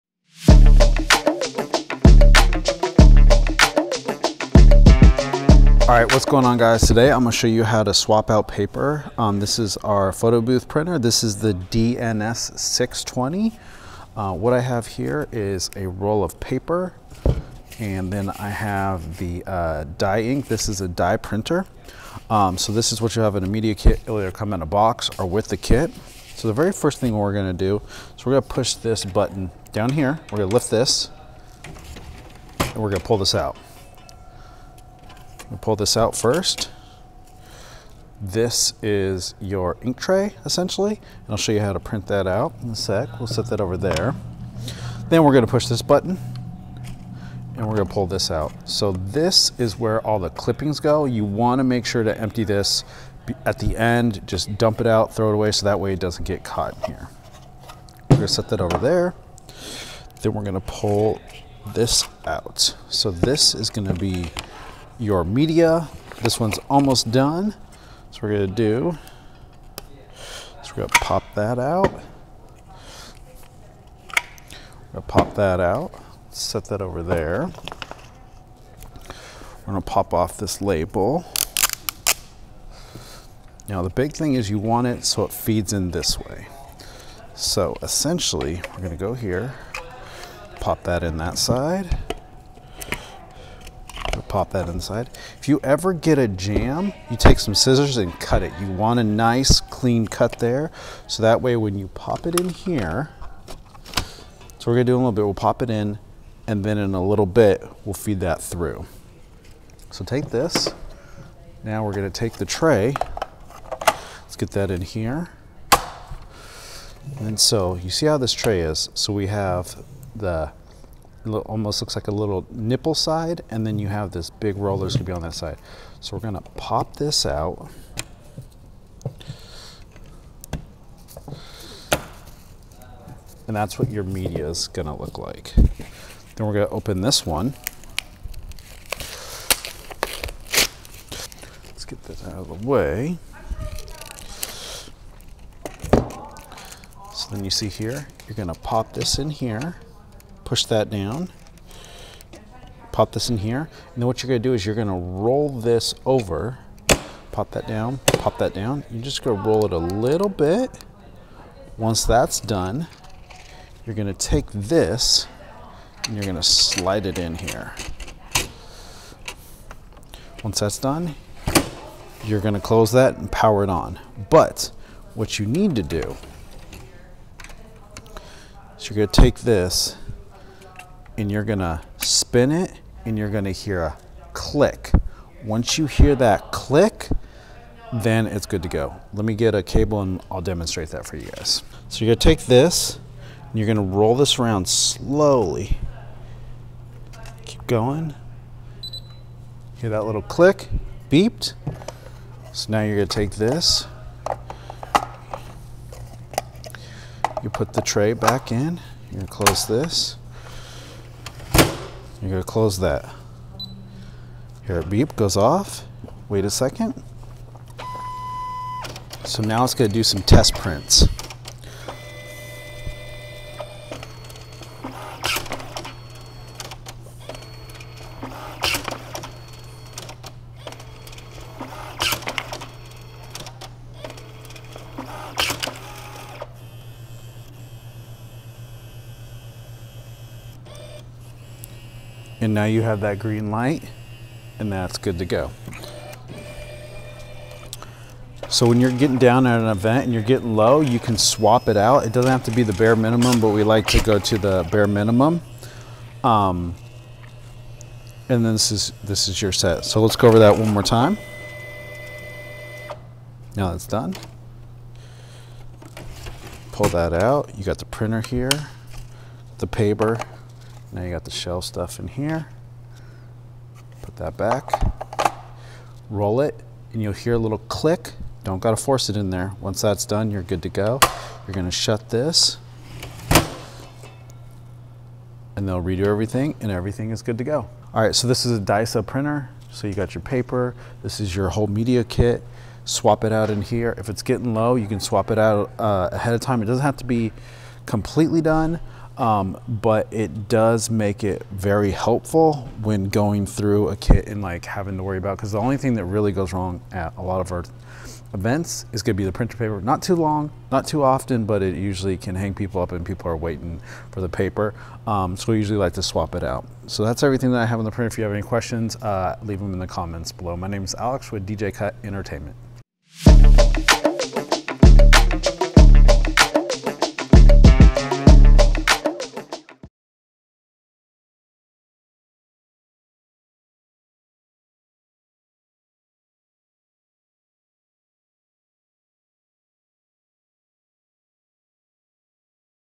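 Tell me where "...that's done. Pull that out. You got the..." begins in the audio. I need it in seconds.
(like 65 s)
263 s.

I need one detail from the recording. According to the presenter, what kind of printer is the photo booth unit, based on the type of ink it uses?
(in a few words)
dye printer.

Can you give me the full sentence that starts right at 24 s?
It'll either come in a box or with the kit.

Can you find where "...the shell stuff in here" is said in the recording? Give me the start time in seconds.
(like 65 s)
271 s.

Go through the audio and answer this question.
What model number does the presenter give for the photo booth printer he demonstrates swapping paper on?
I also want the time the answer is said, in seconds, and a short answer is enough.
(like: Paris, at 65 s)
DNP 620, at 11 s.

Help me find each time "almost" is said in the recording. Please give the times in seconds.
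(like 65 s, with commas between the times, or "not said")
66 s, 121 s.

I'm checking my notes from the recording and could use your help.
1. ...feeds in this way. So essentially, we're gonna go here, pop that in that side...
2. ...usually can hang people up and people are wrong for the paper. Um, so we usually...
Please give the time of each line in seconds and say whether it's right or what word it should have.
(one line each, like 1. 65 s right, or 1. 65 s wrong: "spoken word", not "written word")
1. 85 s right
2. 311 s wrong: "waiting", not "wrong".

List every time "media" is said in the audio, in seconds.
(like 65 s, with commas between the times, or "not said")
23 s, 65 s, 134 s, 291 s.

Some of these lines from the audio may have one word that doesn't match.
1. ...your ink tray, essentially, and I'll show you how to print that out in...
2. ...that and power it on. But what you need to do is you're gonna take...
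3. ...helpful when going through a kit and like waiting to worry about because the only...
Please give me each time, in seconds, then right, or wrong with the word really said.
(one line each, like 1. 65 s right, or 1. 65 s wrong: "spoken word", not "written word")
1. 39 s right
2. 172 s right
3. 301 s wrong: "having", not "waiting".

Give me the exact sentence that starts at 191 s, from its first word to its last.
So you're gonna take this and you're gonna roll this around slowly.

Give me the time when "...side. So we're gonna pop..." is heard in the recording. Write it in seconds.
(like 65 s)
125 s.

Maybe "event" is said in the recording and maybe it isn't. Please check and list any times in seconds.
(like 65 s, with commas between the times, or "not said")
249 s, 308 s.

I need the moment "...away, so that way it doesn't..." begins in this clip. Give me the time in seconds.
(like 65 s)
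55 s.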